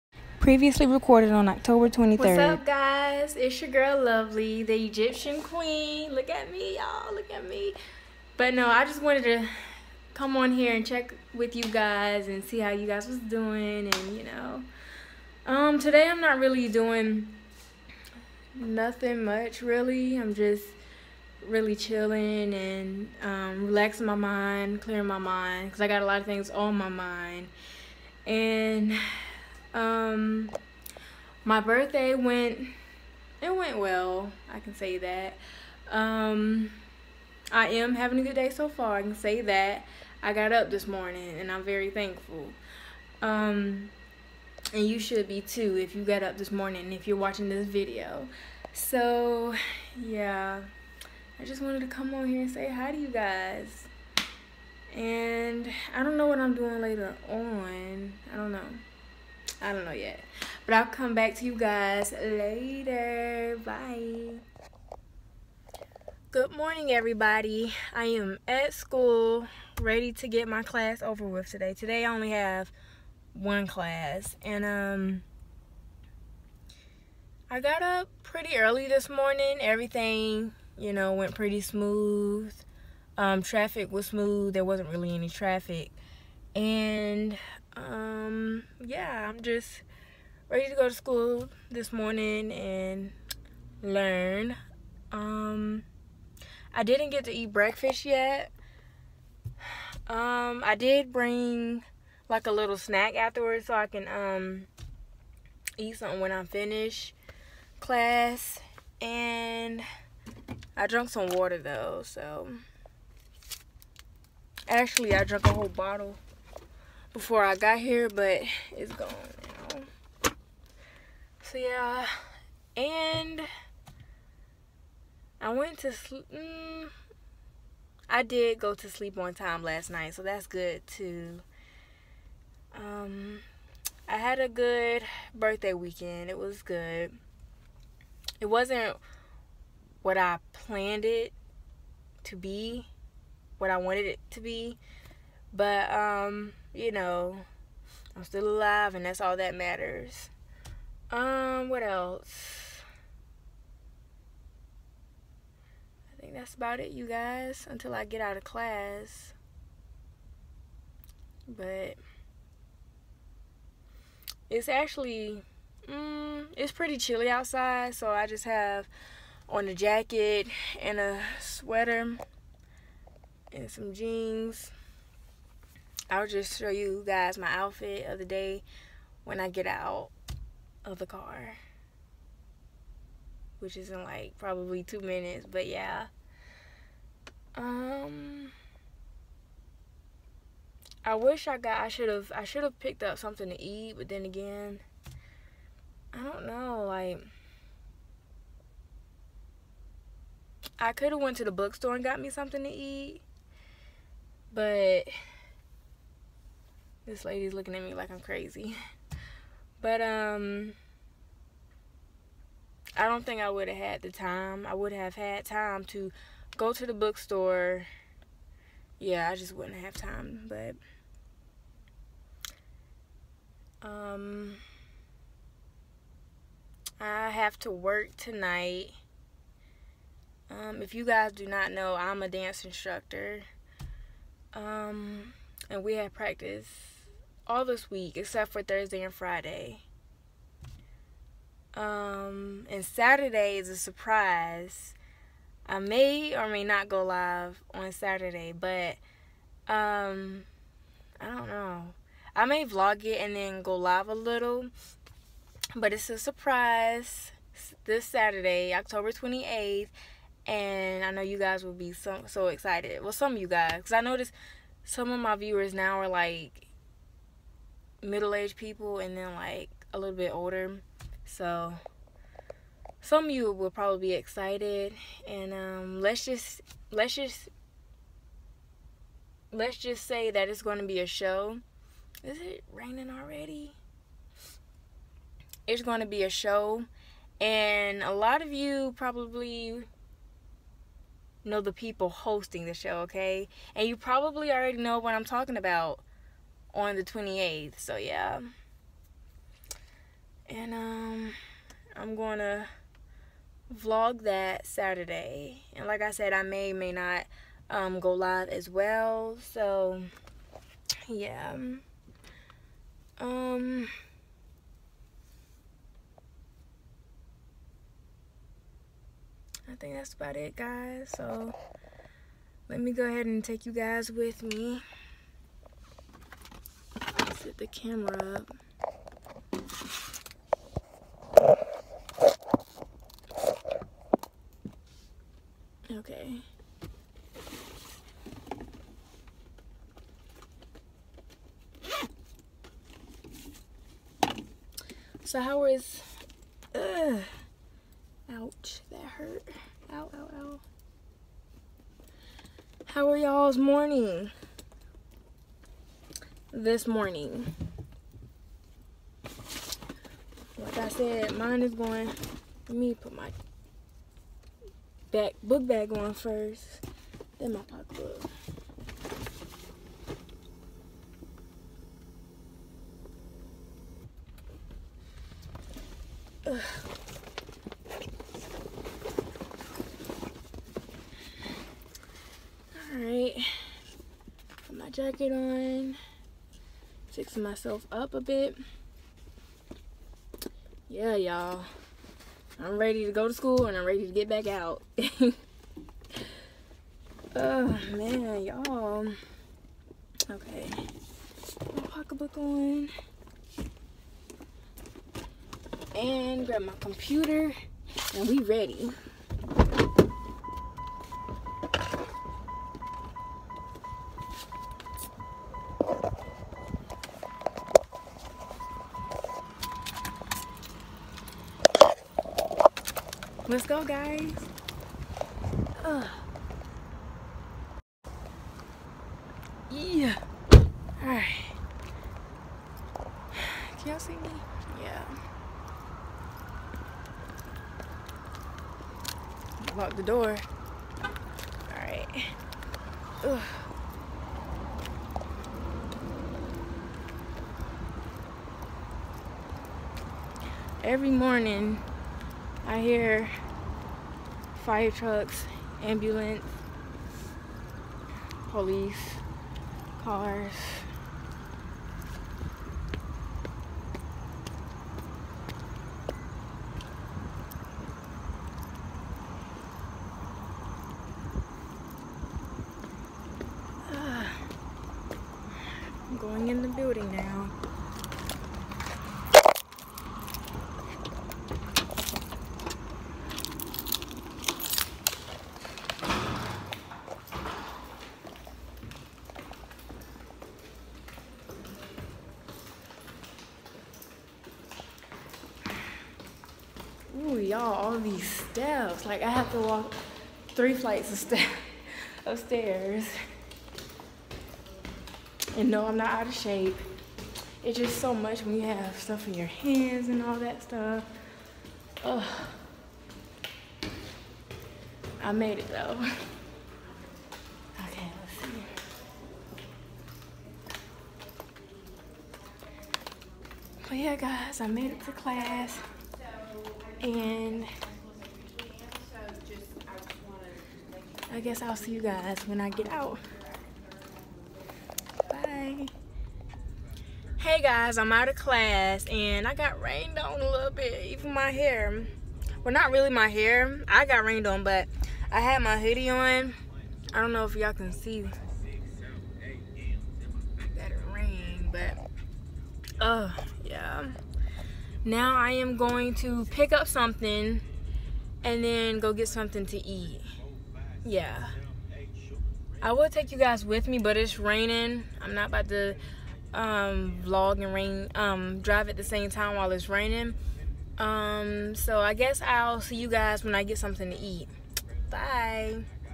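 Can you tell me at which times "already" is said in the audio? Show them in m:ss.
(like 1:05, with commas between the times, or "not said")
4:43, 4:54.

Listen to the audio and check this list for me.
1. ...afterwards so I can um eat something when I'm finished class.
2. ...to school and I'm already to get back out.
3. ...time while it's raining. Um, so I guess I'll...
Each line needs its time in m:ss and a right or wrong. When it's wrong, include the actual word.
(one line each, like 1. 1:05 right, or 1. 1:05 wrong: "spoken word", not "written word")
1. 1:43 right
2. 6:33 wrong: "ready", not "already"
3. 9:29 right.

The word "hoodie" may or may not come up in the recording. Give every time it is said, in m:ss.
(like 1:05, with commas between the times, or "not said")
9:05.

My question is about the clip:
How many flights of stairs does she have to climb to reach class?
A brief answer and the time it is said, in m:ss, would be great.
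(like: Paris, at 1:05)
3, at 8:20.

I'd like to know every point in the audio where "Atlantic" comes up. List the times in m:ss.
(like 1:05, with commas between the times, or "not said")
not said.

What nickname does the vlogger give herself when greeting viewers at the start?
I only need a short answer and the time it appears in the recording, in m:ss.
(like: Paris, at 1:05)
The Egyptian Queen, at 0:04.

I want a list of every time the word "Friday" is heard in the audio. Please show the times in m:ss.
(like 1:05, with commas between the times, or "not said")
3:59.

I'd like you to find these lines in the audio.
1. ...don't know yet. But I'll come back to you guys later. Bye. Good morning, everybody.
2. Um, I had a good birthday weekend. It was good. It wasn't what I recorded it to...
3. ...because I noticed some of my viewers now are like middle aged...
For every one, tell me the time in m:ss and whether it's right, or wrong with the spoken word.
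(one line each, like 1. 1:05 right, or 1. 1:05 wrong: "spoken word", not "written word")
1. 0:59 right
2. 2:12 wrong: "planned", not "recorded"
3. 4:23 right.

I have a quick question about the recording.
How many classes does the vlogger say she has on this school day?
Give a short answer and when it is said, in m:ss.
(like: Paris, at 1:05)
1, at 1:13.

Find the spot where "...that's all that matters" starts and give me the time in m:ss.
2:29.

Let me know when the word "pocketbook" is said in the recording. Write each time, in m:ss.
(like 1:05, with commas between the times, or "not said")
6:07, 6:41.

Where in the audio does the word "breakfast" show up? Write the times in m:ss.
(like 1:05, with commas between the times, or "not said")
1:37.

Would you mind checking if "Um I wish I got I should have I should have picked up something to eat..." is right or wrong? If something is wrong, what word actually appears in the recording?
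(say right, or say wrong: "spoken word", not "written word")
right.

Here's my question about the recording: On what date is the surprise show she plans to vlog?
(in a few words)
October 28.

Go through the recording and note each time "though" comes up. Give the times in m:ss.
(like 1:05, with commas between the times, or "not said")
1:51, 8:35.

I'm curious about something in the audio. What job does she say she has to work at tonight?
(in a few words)
Dance instructor.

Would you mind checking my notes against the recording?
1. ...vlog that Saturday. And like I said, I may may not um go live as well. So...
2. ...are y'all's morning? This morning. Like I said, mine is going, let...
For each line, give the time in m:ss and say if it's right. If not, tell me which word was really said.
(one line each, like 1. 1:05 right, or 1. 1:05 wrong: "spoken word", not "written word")
1. 5:03 right
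2. 5:53 right.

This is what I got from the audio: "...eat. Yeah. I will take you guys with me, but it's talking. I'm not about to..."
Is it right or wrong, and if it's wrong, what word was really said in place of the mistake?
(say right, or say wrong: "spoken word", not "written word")
wrong: "raining", not "talking".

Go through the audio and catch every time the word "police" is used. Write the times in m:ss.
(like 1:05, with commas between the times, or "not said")
7:38.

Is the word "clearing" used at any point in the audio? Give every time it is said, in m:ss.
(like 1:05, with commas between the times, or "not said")
0:24.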